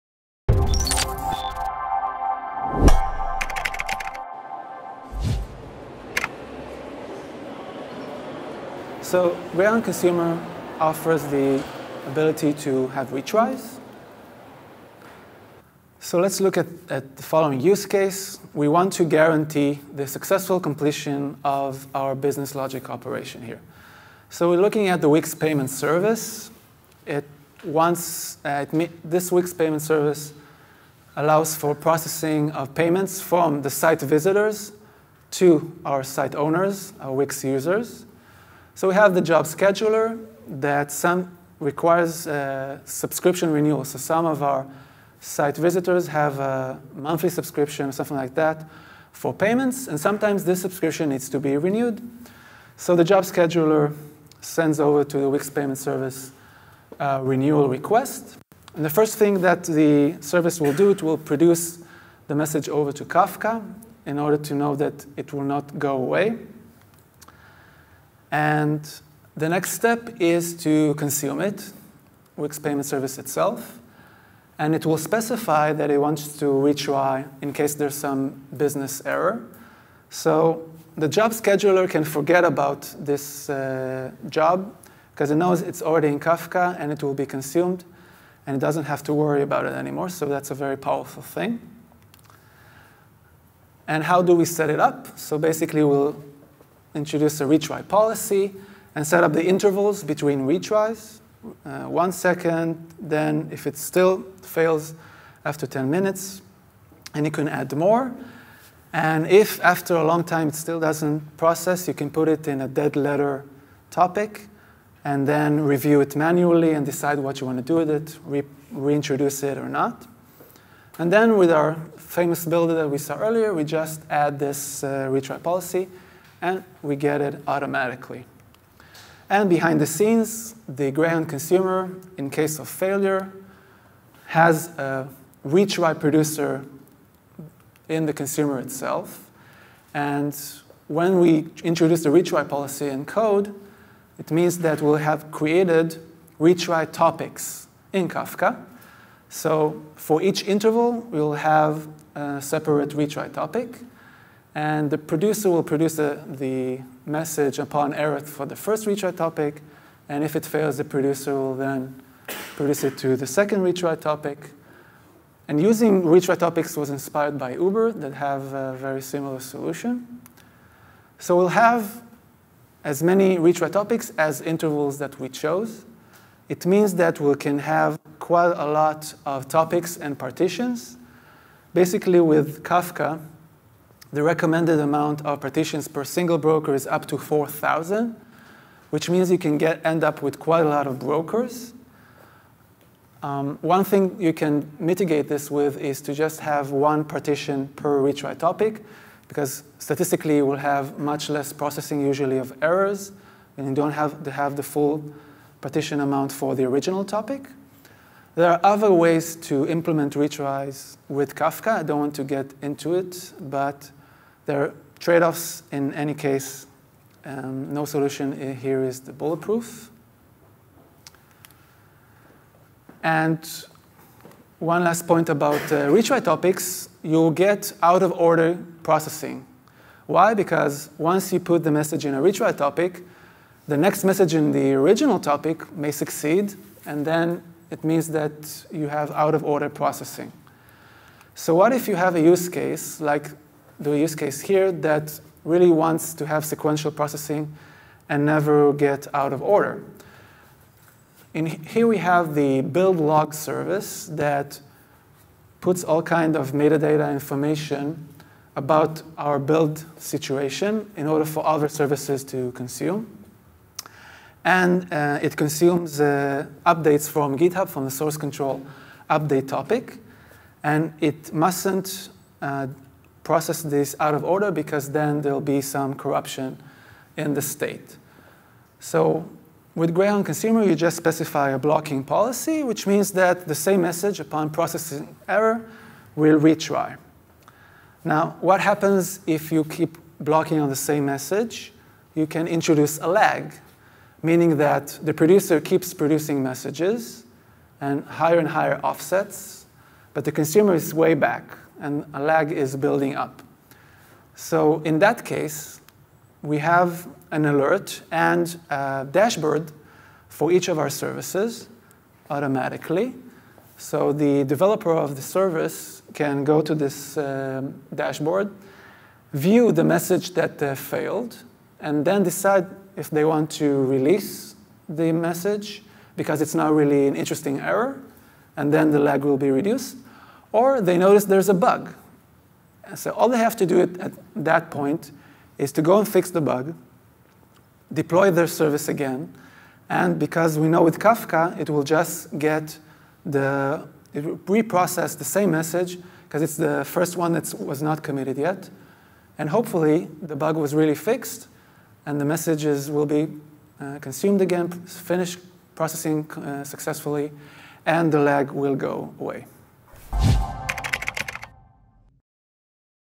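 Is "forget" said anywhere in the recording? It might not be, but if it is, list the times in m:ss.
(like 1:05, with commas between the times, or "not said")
1:22.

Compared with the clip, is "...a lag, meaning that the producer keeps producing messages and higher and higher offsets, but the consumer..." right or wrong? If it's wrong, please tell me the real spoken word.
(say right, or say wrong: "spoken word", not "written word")
right.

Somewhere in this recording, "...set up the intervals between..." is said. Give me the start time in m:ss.
1:39.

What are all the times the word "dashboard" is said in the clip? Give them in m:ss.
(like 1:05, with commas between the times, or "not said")
5:09, 5:17.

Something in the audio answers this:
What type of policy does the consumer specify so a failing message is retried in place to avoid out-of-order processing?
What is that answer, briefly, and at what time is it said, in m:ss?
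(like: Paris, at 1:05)
blocking policy, at 4:41.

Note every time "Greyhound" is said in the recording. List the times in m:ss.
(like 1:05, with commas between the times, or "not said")
0:09, 2:10, 4:39.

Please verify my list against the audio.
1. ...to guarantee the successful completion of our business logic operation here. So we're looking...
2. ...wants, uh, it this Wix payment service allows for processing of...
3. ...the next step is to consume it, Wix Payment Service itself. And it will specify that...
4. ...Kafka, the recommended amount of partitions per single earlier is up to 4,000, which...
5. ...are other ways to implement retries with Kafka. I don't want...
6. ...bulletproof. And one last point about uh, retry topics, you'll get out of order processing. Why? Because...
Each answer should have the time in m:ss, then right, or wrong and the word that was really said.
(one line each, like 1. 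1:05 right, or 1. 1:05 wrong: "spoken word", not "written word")
1. 0:18 right
2. 0:27 right
3. 1:09 right
4. 3:02 wrong: "broker", not "earlier"
5. 3:28 right
6. 3:39 right.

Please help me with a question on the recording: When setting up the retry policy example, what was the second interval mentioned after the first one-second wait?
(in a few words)
10 minutes.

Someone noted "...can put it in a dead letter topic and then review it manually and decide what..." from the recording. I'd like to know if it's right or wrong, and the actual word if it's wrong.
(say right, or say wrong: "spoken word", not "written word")
right.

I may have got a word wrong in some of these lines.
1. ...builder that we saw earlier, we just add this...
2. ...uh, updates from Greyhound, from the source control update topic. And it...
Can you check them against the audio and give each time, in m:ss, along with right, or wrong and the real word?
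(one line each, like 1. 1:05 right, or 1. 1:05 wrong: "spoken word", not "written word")
1. 2:02 right
2. 4:26 wrong: "GitHub", not "Greyhound".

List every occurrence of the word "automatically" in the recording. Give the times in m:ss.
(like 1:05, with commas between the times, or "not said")
2:07, 5:12.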